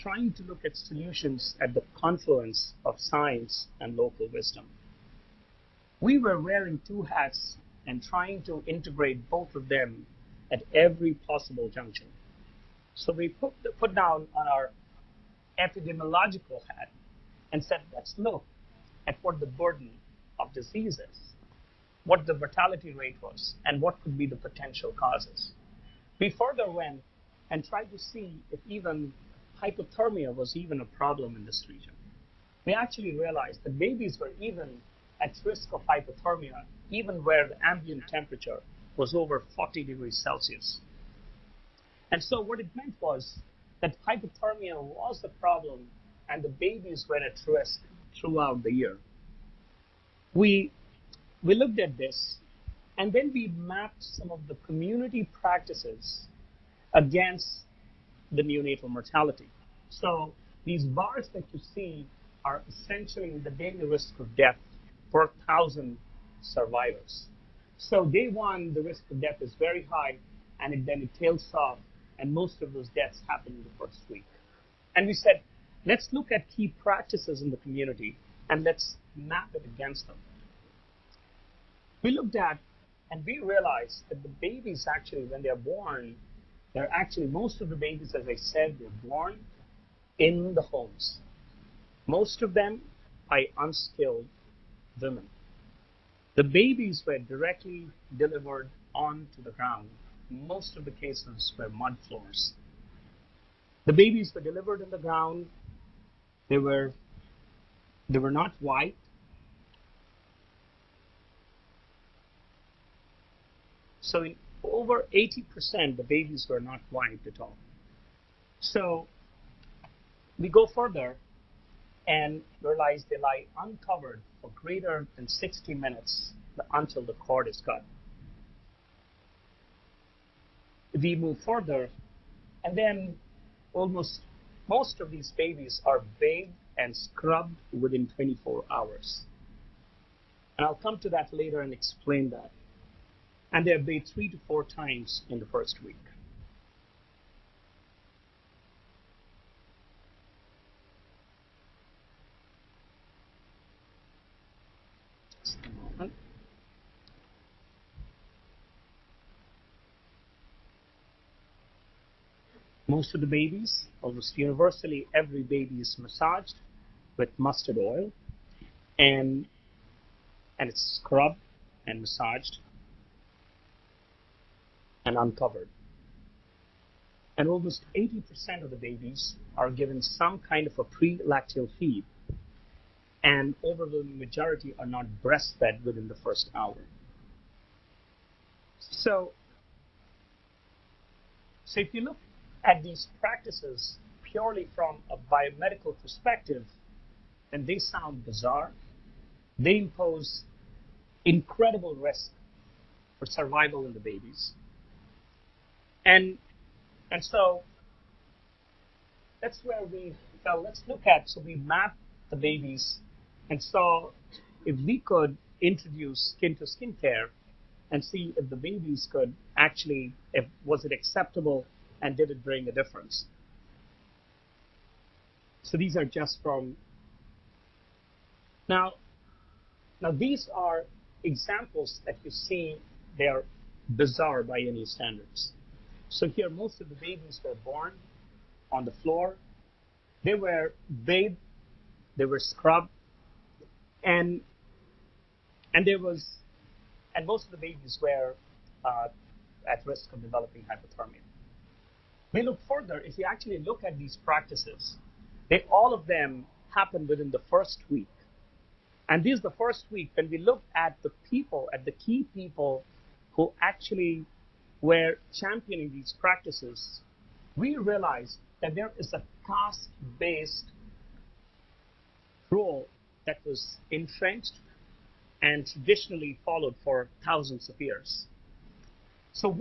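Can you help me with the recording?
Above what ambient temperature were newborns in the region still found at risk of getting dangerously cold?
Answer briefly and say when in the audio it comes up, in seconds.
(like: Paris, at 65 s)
40 degrees Celsius, at 39 s.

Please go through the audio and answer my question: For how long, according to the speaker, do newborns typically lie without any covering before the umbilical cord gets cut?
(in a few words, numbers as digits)
Greater than 60 minutes.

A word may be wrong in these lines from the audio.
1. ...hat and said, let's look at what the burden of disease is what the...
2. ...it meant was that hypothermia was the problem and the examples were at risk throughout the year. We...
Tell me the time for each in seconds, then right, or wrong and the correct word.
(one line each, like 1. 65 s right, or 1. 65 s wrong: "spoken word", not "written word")
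1. 16 s right
2. 42 s wrong: "babies", not "examples".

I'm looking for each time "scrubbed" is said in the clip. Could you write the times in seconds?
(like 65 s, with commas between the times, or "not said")
136 s, 171 s, 242 s.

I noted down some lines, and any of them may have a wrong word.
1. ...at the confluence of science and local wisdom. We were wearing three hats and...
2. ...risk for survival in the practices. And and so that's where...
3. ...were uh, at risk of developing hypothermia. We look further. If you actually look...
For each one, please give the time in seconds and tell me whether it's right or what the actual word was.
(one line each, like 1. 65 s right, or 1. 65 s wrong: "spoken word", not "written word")
1. 1 s wrong: "two", not "three"
2. 201 s wrong: "babies", not "practices"
3. 248 s right.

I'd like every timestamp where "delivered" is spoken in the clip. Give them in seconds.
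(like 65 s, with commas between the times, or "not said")
98 s, 104 s.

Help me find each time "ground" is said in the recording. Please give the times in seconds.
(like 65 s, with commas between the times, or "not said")
99 s, 104 s.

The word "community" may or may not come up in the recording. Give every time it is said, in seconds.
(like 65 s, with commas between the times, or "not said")
54 s, 77 s.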